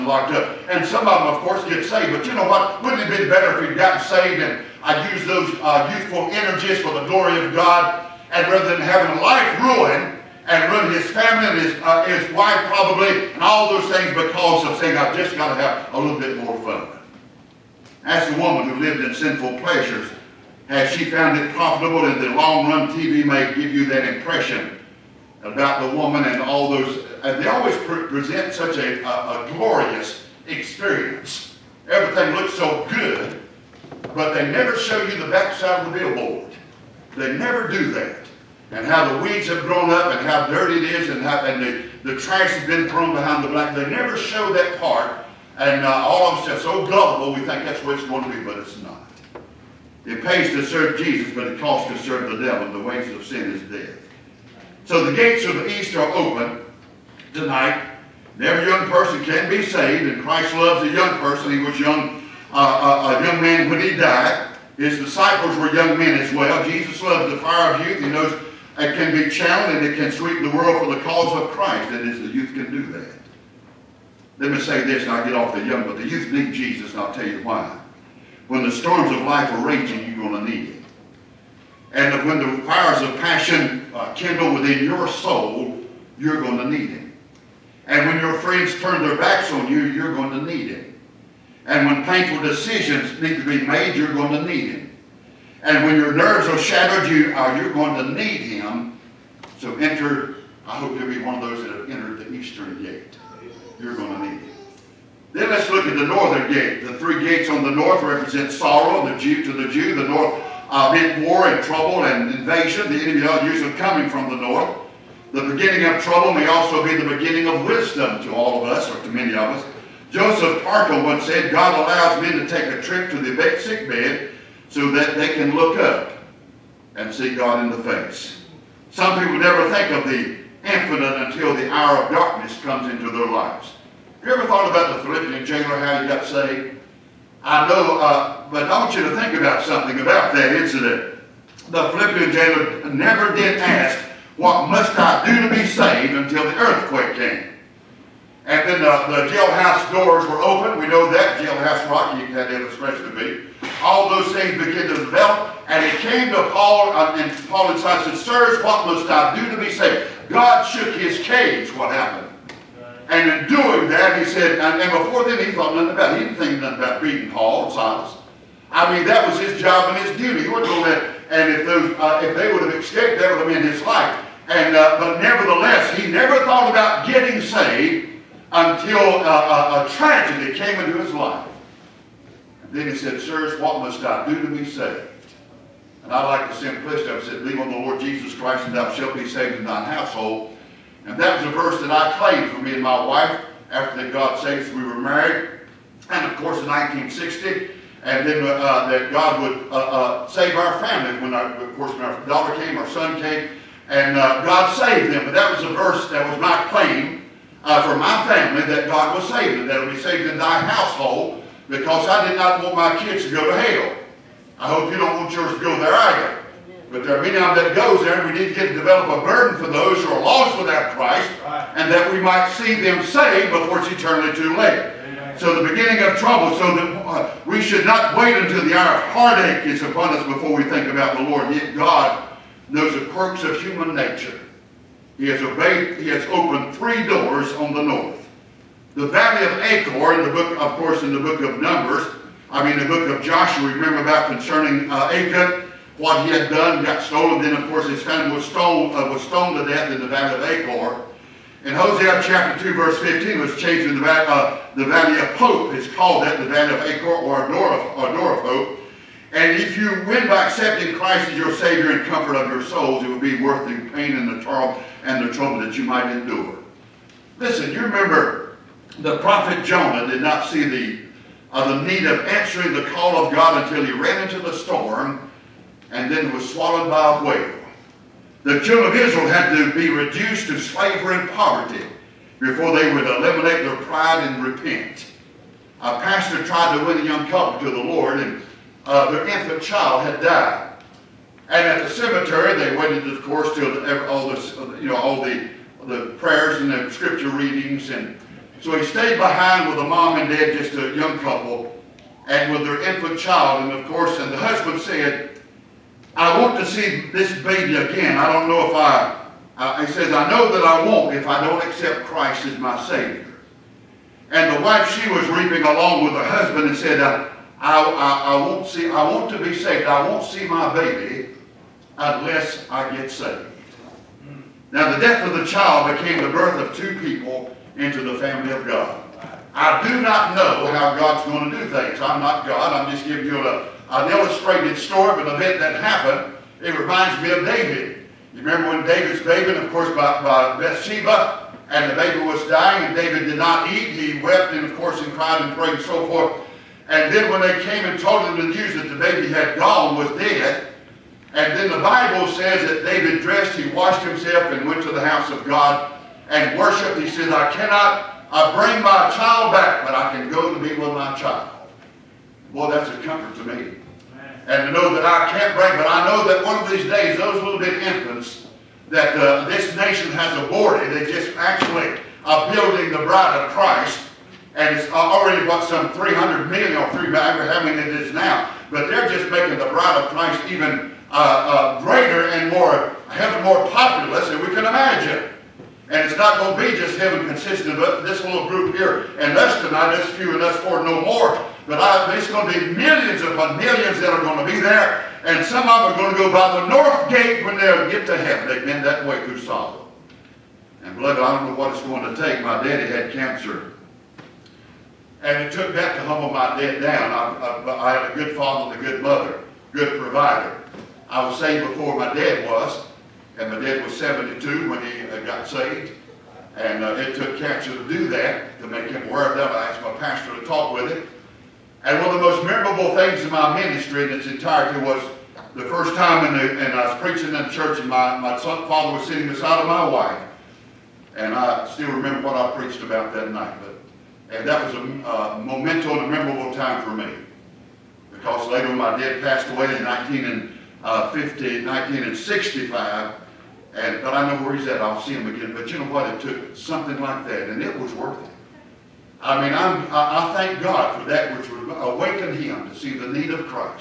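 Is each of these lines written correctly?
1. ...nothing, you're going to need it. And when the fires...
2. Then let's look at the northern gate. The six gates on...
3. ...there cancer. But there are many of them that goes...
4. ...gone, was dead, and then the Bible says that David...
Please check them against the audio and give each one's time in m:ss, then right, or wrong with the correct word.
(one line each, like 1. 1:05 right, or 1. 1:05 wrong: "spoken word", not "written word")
1. 1:19 wrong: "raging", not "nothing"
2. 1:45 wrong: "three", not "six"
3. 3:35 wrong: "either", not "cancer"
4. 5:49 right.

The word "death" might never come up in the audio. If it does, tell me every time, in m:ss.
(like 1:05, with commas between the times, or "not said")
0:53, 4:09, 5:25.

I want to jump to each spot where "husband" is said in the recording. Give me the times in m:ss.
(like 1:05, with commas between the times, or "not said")
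5:04, 5:16.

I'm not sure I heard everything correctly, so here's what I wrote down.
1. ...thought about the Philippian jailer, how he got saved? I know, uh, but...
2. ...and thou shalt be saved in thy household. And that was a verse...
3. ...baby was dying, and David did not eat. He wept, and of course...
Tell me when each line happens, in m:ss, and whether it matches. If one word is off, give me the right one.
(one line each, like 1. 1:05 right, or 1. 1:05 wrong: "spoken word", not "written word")
1. 2:14 right
2. 3:08 right
3. 5:41 right.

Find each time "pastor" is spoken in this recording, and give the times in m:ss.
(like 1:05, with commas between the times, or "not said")
4:45, 6:59.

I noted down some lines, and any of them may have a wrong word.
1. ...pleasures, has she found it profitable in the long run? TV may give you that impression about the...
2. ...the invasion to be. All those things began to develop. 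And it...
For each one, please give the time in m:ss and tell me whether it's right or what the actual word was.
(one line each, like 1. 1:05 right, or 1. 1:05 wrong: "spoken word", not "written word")
1. 0:19 right
2. 2:32 wrong: "illustration", not "invasion".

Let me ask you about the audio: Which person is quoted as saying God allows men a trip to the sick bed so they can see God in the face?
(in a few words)
Joseph Parker.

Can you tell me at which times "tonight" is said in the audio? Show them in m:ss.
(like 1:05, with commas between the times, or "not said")
0:57, 6:29.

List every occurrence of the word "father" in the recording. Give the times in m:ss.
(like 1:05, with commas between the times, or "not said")
6:48, 7:08.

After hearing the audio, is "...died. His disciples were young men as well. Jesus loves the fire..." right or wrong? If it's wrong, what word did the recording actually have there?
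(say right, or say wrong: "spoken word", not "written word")
right.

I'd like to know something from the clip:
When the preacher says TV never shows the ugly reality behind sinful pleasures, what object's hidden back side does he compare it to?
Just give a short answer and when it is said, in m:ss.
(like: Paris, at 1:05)
billboard, at 0:35.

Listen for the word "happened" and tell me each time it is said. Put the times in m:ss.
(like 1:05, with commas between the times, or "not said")
2:41, 5:35.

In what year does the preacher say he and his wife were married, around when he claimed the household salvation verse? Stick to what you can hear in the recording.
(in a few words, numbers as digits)
1960.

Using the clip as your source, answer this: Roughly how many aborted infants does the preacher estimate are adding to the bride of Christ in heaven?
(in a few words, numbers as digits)
300 million.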